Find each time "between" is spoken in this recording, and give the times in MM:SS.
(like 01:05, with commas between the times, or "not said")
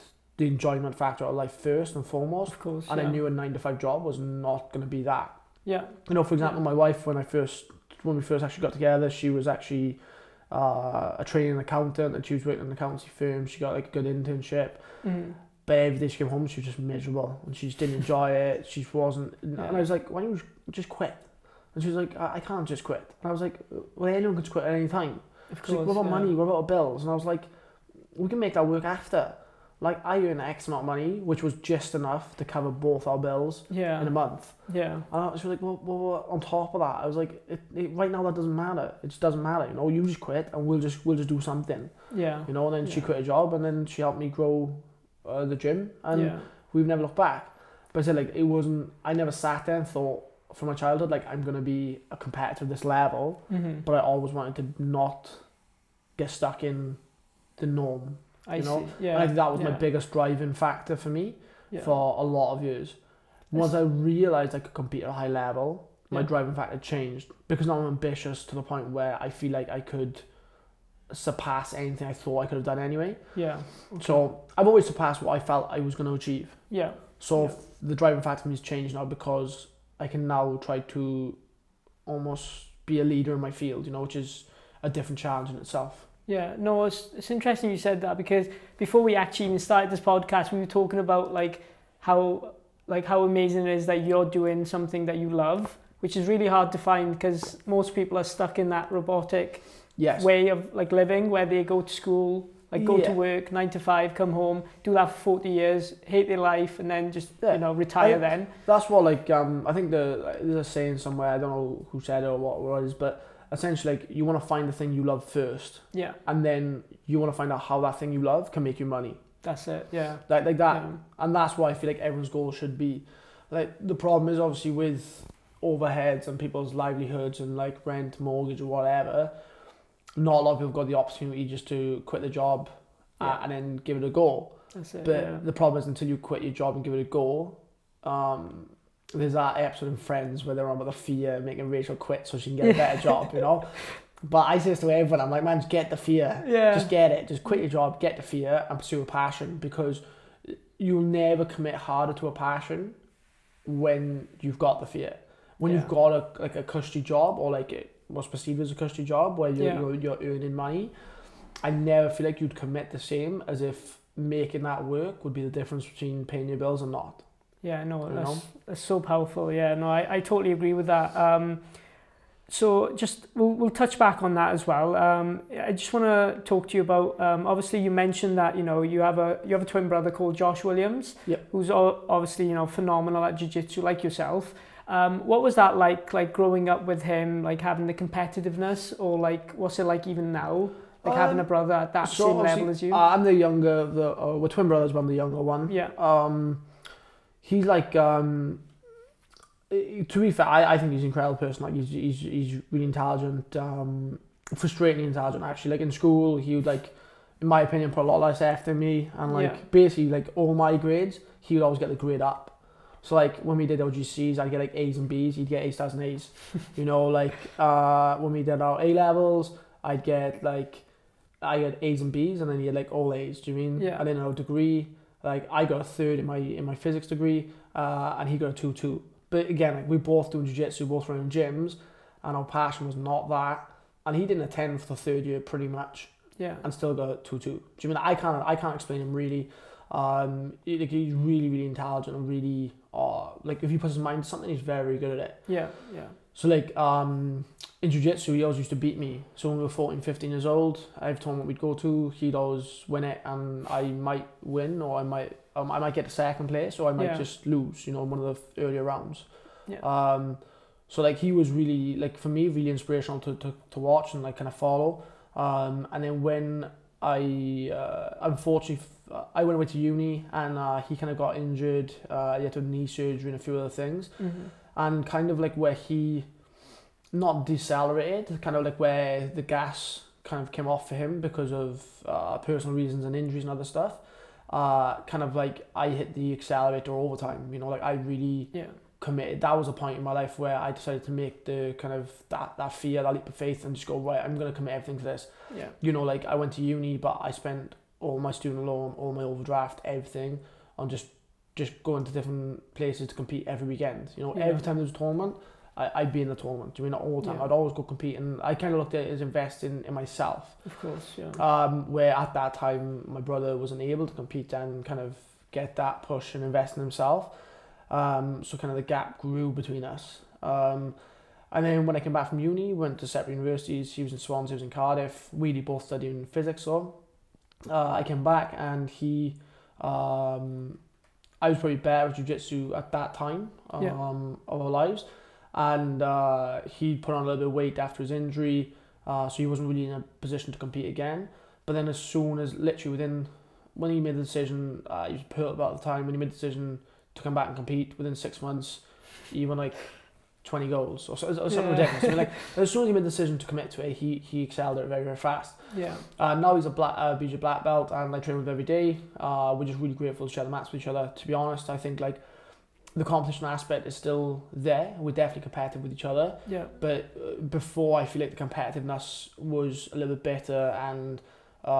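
02:45, 05:19.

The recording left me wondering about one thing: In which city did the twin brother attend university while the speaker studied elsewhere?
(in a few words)
Swansea.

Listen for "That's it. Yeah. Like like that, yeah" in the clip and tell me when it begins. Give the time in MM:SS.
01:59.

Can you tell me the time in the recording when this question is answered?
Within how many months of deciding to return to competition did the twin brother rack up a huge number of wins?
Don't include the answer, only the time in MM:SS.
05:48.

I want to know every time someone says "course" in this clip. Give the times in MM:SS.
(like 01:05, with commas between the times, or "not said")
00:02, 00:25, 05:10.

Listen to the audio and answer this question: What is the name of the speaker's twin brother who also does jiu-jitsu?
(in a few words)
Josh Williams.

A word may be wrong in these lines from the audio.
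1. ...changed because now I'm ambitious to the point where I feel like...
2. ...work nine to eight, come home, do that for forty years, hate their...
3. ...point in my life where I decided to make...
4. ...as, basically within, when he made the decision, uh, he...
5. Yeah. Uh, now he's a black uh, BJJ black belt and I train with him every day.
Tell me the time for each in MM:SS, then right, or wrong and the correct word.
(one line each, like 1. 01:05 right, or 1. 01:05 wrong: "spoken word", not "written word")
1. 01:06 right
2. 01:43 wrong: "five", not "eight"
3. 04:49 right
4. 05:42 wrong: "literally", not "basically"
5. 05:55 right.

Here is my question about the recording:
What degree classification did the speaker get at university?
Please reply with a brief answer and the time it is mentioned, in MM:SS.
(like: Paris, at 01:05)
A third, at 03:45.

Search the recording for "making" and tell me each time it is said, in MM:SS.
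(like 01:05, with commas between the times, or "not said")
02:21, 02:44.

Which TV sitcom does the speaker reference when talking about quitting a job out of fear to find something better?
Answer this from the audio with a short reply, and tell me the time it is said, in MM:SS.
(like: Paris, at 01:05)
Friends, at 02:19.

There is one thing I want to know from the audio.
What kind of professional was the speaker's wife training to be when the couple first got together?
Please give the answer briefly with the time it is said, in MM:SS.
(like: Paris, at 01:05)
Accountant, at 00:11.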